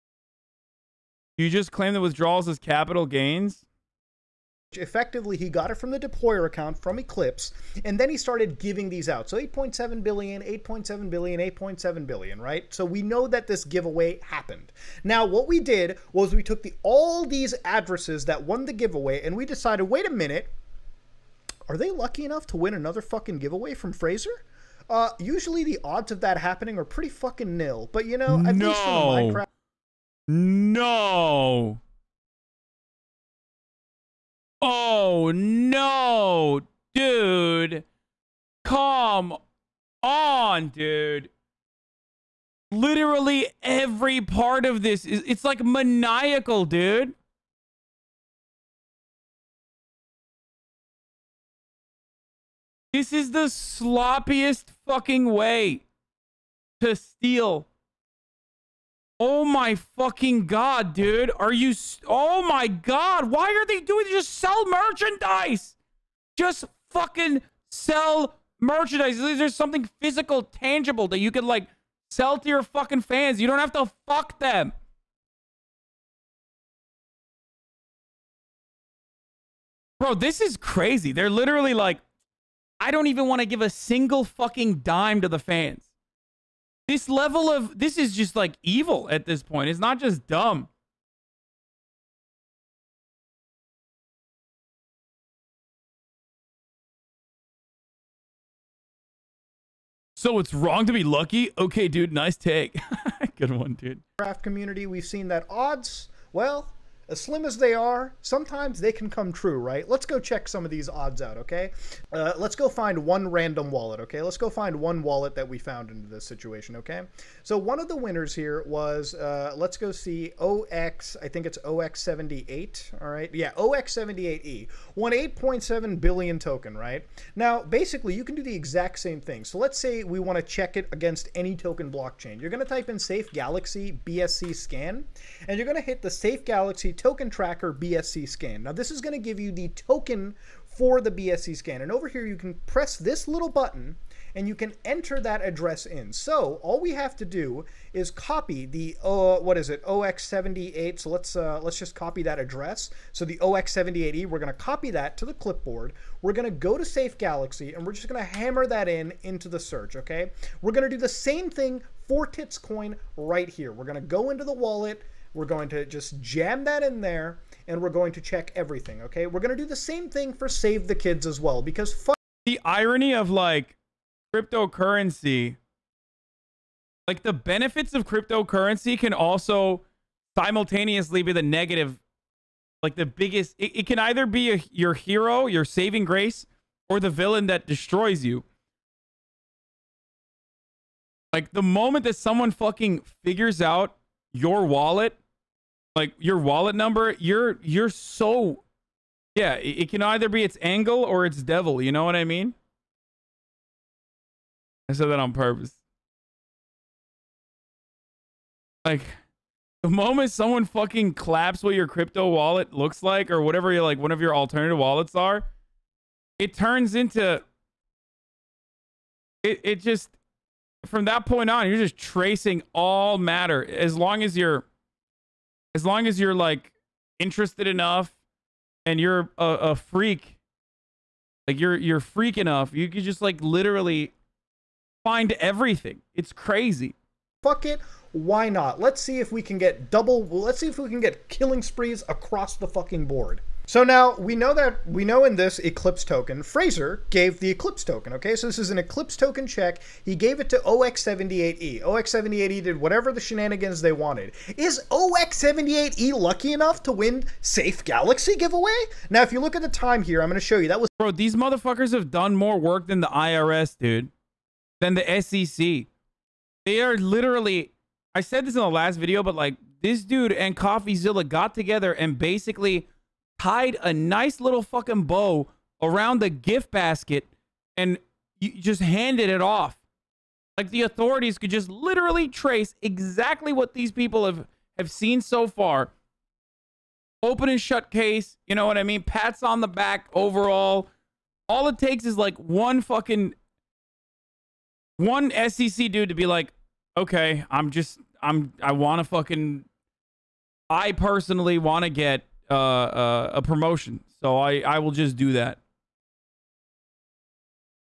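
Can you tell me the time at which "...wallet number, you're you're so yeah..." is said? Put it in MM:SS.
03:16.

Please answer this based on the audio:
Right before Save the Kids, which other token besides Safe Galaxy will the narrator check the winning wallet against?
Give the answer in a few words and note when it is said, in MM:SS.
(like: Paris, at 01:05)
Titscoin, at 02:42.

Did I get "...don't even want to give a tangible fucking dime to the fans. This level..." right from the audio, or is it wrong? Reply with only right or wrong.
wrong.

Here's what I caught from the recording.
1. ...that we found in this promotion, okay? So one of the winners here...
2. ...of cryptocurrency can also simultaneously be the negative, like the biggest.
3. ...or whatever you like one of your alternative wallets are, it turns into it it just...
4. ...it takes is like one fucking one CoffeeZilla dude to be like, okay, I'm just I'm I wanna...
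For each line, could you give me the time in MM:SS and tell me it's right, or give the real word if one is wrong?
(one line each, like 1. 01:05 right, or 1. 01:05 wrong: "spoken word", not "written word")
1. 01:55 wrong: "situation", not "promotion"
2. 02:57 right
3. 03:33 right
4. 04:51 wrong: "SEC", not "CoffeeZilla".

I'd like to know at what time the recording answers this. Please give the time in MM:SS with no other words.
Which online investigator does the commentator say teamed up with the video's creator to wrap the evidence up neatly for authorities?
04:30.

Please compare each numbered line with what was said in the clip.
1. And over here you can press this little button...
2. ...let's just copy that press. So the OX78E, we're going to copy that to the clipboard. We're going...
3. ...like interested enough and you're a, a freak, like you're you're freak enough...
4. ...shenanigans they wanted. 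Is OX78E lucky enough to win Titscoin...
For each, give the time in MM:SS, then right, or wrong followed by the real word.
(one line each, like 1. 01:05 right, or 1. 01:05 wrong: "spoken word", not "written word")
1. 02:21 right
2. 02:31 wrong: "address", not "press"
3. 03:46 right
4. 04:13 wrong: "Safe", not "Titscoin".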